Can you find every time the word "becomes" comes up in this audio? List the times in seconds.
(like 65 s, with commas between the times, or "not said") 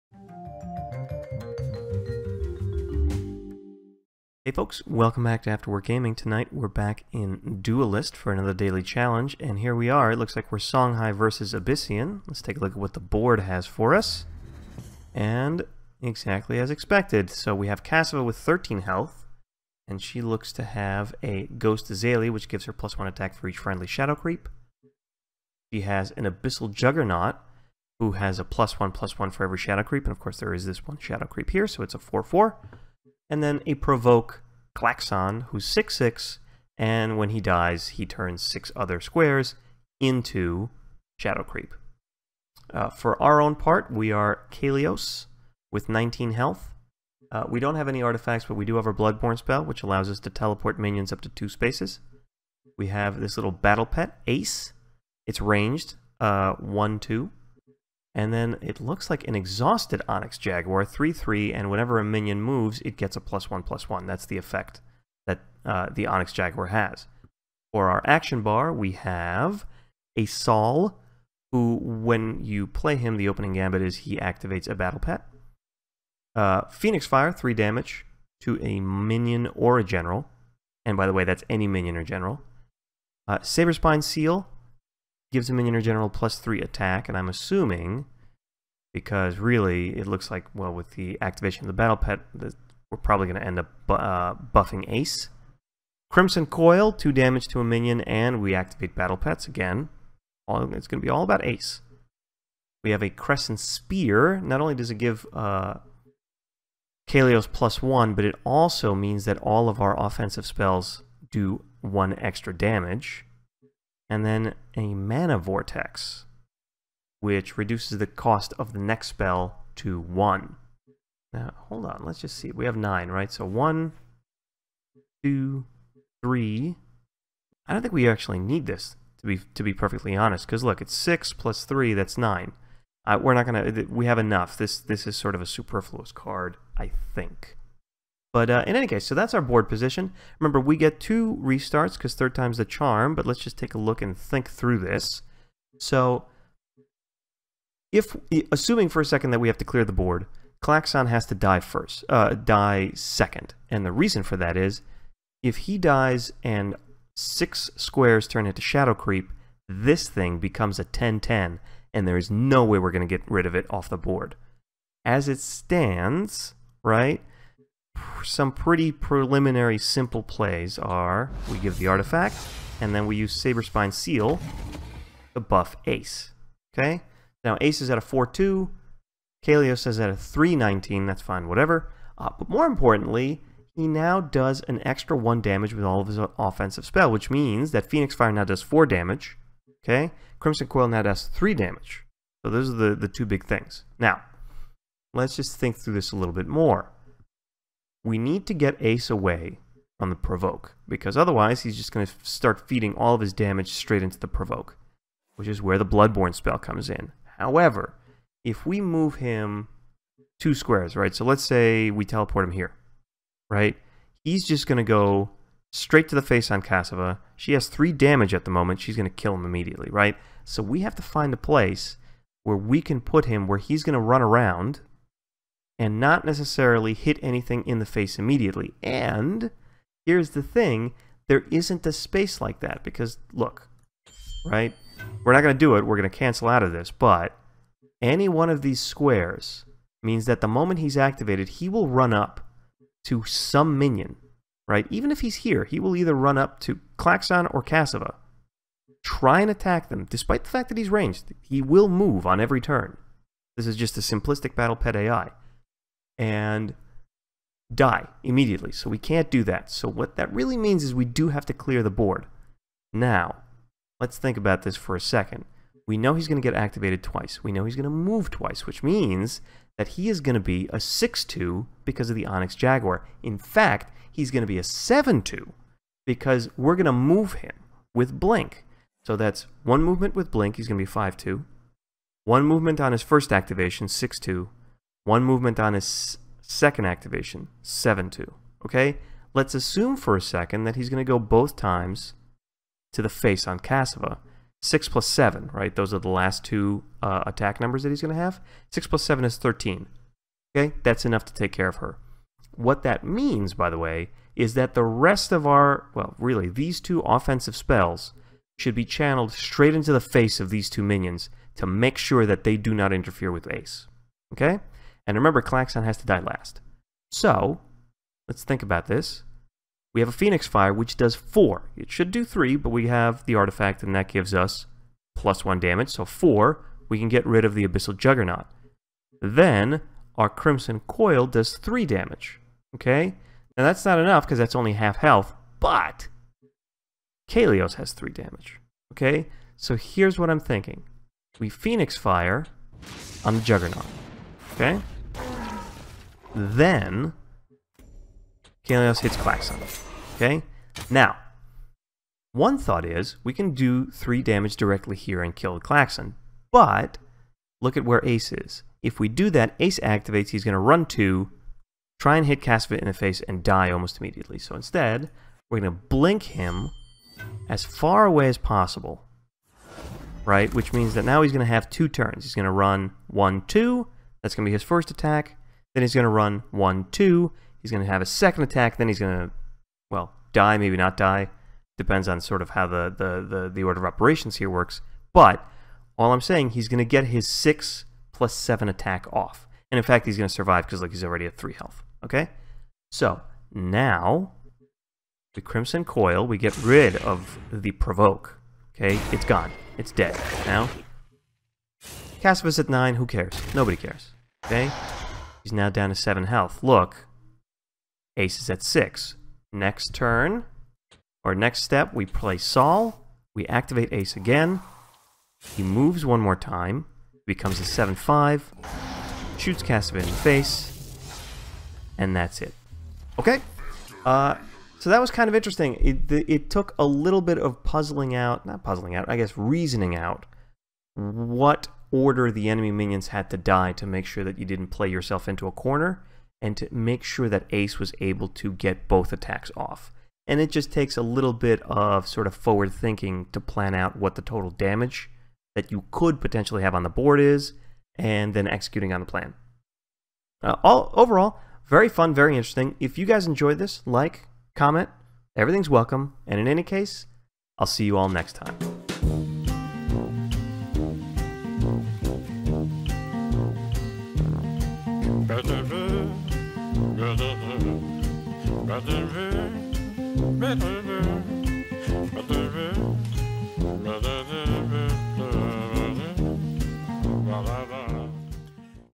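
160 s, 417 s.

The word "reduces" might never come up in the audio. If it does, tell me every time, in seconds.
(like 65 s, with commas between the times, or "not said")
117 s.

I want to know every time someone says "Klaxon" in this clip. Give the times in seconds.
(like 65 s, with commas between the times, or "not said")
34 s, 150 s, 246 s, 315 s, 349 s, 355 s.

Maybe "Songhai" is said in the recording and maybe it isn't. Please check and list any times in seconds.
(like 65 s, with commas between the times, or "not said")
10 s.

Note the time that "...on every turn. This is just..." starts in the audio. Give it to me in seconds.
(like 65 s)
252 s.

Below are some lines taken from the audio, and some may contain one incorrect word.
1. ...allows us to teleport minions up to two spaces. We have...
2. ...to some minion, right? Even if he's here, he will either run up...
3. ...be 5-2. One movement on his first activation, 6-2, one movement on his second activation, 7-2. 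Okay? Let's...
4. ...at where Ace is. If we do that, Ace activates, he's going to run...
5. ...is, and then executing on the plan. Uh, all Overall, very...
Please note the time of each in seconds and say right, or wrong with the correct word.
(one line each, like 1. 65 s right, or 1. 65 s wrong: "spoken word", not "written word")
1. 49 s right
2. 243 s right
3. 280 s right
4. 357 s right
5. 447 s right.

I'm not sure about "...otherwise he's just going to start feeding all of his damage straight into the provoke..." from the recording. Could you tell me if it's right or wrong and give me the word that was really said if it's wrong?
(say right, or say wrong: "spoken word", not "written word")
right.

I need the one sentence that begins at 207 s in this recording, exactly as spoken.
However, if we move him two squares, right?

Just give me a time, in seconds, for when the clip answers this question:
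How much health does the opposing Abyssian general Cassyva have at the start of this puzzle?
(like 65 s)
18 s.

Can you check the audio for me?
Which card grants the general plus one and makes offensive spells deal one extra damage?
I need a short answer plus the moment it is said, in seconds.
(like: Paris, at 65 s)
Crescent Spear, at 103 s.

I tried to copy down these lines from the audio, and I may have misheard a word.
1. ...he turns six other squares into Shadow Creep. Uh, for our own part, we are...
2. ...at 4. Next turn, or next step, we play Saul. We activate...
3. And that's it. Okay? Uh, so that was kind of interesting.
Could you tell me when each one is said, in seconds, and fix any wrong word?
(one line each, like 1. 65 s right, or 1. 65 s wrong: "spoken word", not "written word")
1. 37 s right
2. 408 s wrong: "6", not "4"
3. 421 s right.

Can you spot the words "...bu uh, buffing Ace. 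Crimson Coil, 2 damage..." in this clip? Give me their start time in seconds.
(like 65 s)
93 s.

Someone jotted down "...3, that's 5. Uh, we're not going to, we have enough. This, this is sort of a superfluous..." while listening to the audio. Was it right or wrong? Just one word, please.
wrong.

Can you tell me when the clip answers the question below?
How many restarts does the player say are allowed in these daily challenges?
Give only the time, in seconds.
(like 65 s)
140 s.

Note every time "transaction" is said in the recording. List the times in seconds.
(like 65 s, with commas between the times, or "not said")
not said.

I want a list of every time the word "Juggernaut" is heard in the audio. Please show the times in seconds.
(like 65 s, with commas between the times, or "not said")
26 s, 327 s, 343 s.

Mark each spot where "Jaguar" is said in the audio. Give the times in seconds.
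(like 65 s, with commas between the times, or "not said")
60 s, 66 s, 272 s.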